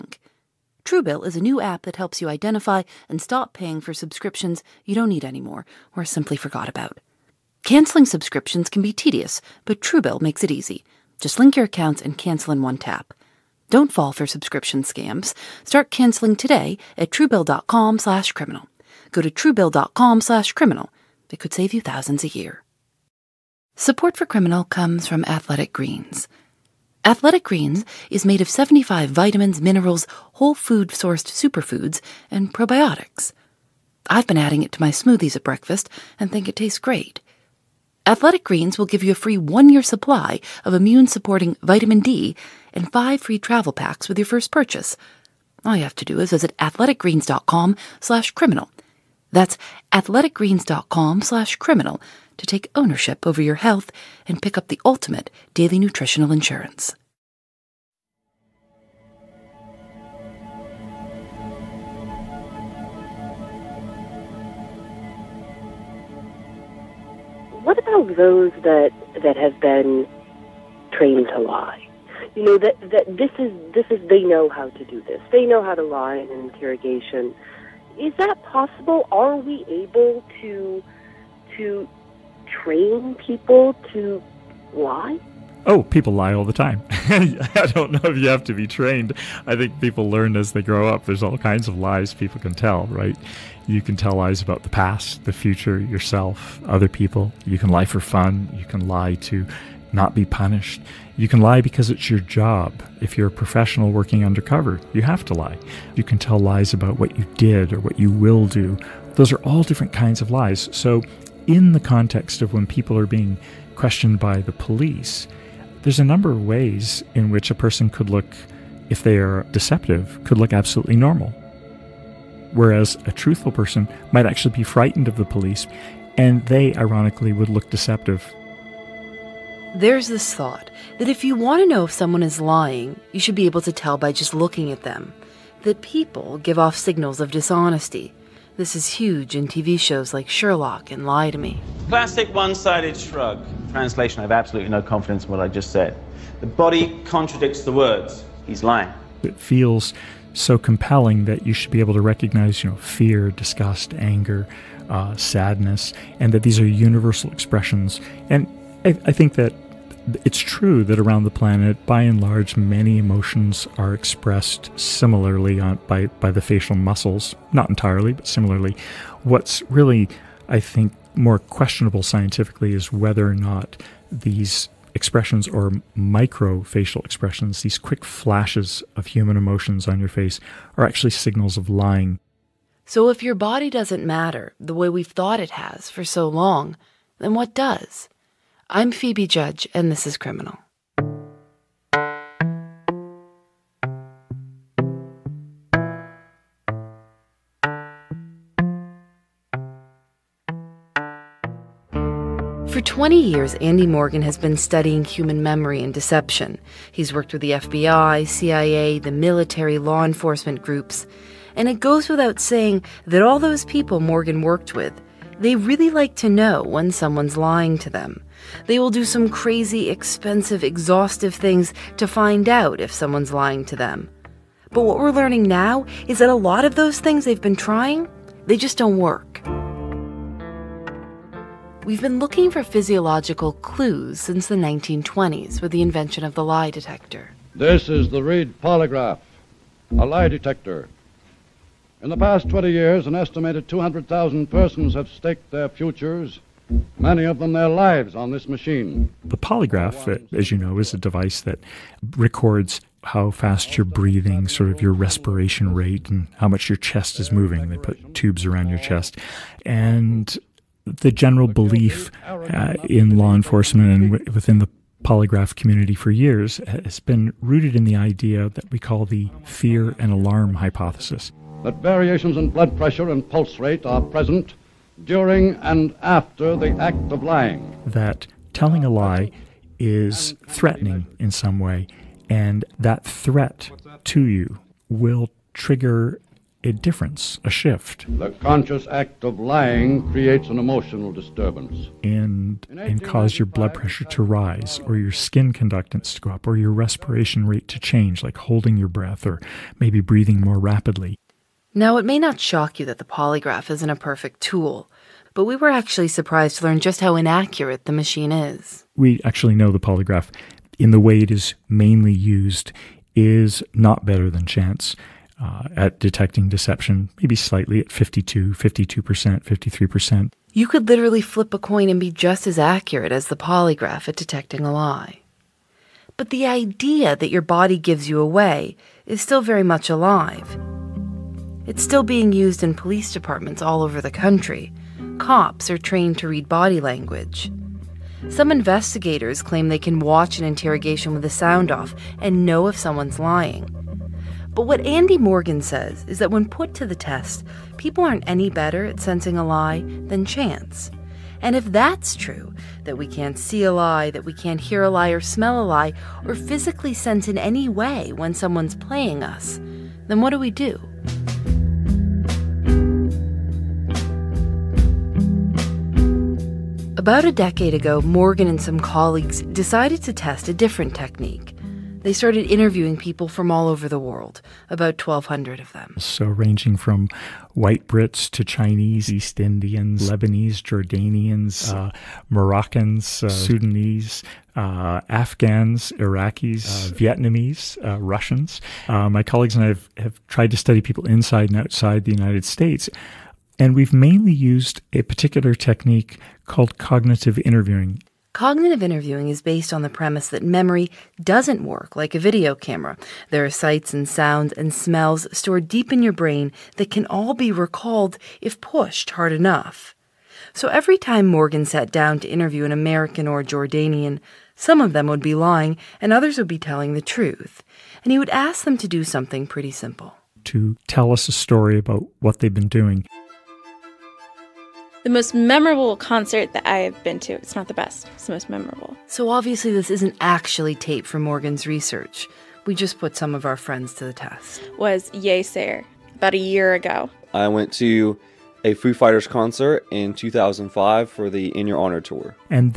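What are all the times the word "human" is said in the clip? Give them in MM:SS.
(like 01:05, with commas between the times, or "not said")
02:59, 03:25.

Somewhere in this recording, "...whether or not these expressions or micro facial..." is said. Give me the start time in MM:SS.
02:52.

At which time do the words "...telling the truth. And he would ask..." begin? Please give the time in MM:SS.
06:56.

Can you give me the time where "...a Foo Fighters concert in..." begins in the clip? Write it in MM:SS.
07:18.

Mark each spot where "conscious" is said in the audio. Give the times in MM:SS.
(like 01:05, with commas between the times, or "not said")
04:48.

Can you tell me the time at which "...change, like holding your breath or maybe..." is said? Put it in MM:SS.
04:57.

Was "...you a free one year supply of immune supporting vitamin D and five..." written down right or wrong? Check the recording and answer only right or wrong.
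right.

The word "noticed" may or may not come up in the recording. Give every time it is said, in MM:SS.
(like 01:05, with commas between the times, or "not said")
not said.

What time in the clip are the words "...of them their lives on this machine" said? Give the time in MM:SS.
04:07.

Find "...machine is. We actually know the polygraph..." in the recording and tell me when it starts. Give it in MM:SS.
05:07.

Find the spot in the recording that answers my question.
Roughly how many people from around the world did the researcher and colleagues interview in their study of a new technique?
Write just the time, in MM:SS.
06:14.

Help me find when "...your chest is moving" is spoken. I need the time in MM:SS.
04:16.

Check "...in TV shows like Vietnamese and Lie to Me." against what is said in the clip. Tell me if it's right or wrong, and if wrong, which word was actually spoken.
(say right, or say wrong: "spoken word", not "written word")
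wrong: "Sherlock", not "Vietnamese".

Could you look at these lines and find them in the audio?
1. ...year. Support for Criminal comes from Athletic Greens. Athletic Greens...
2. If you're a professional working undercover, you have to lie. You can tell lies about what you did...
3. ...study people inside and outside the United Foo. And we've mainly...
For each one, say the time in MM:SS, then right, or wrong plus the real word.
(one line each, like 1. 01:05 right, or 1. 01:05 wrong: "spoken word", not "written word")
1. 00:22 right
2. 01:43 right
3. 06:30 wrong: "States", not "Foo".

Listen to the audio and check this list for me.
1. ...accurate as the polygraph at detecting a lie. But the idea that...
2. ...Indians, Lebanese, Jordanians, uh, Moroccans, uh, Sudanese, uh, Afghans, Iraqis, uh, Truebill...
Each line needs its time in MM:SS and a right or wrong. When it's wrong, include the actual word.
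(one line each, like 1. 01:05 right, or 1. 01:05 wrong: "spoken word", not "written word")
1. 05:22 right
2. 06:19 wrong: "Vietnamese", not "Truebill".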